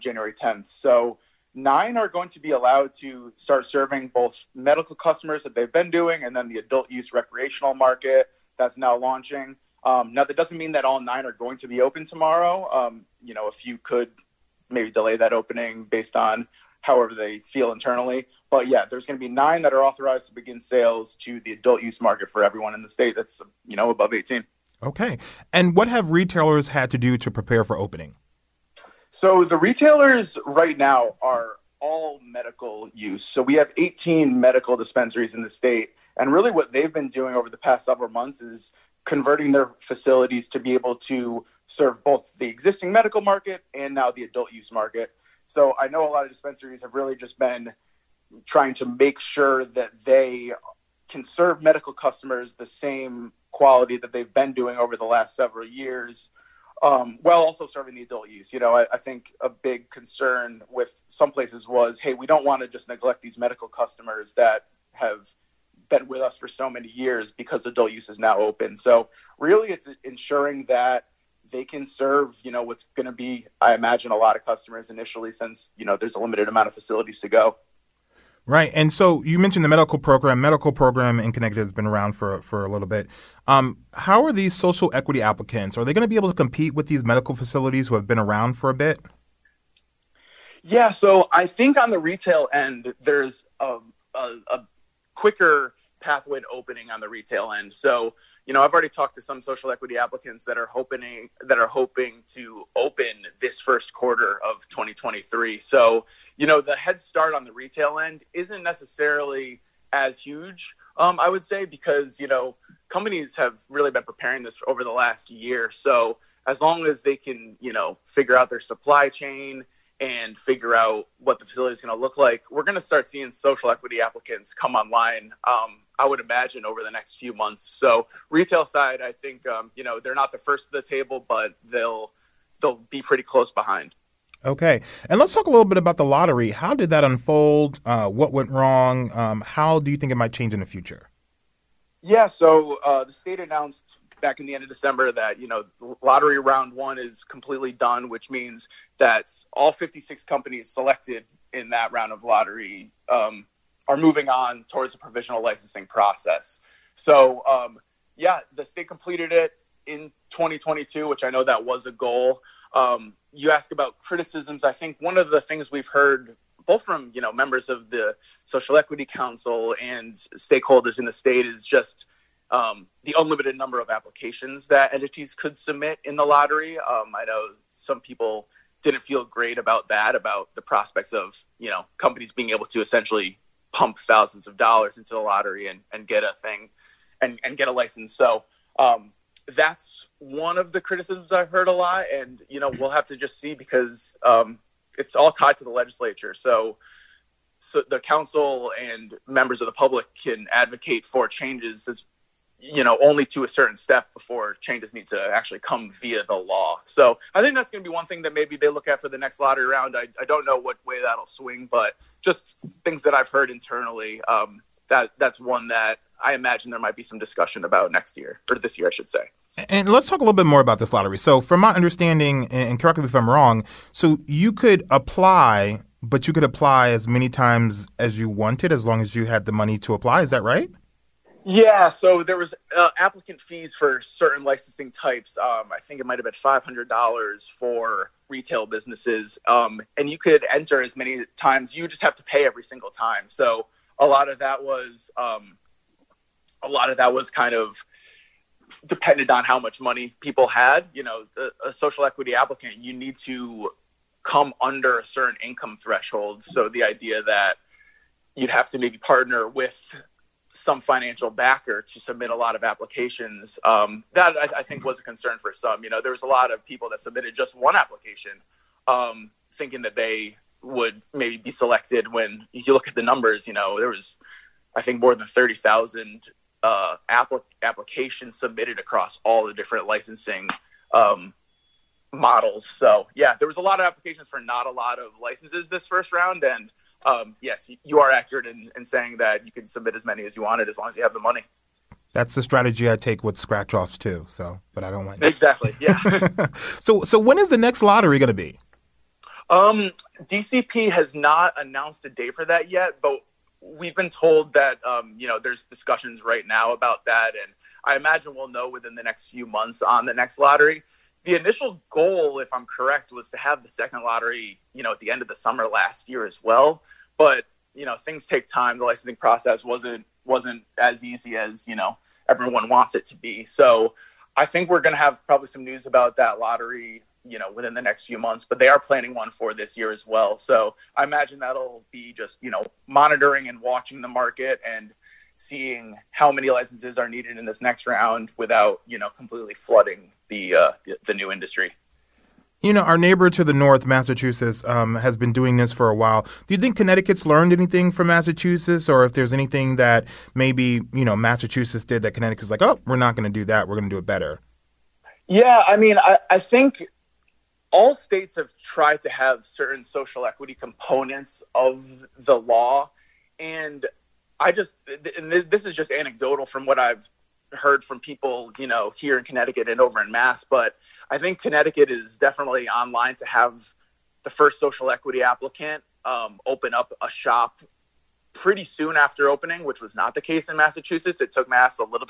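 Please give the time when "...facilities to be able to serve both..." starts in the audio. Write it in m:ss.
0:39.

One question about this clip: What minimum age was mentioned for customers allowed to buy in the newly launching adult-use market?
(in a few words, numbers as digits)
18.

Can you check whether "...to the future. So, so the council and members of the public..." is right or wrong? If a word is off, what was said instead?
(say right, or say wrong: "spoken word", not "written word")
wrong: "legislature", not "future".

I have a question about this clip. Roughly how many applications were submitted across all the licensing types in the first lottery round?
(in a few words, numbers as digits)
More than 30,000.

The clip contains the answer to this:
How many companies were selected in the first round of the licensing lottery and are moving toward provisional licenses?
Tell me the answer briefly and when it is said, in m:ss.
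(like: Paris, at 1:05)
56, at 2:29.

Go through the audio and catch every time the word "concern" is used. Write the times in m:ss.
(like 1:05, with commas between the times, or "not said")
0:59, 4:25.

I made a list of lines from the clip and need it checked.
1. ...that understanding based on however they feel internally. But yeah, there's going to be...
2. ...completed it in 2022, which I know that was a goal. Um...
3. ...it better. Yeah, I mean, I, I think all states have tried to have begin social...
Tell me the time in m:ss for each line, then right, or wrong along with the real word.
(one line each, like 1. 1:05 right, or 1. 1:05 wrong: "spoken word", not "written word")
1. 0:15 wrong: "opening", not "understanding"
2. 2:38 right
3. 5:53 wrong: "certain", not "begin".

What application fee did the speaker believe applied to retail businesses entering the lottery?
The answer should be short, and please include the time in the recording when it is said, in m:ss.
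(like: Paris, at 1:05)
$500, at 3:56.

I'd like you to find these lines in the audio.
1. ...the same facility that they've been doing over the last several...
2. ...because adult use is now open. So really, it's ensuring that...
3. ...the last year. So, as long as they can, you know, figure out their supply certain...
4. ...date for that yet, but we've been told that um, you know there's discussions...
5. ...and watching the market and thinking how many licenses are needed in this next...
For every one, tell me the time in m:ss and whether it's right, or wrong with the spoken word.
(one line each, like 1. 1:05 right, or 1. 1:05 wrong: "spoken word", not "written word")
1. 0:52 wrong: "quality", not "facility"
2. 1:07 right
3. 1:54 wrong: "chain", not "certain"
4. 5:02 right
5. 5:33 wrong: "seeing", not "thinking".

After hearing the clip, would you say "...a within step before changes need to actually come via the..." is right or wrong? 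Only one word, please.
wrong.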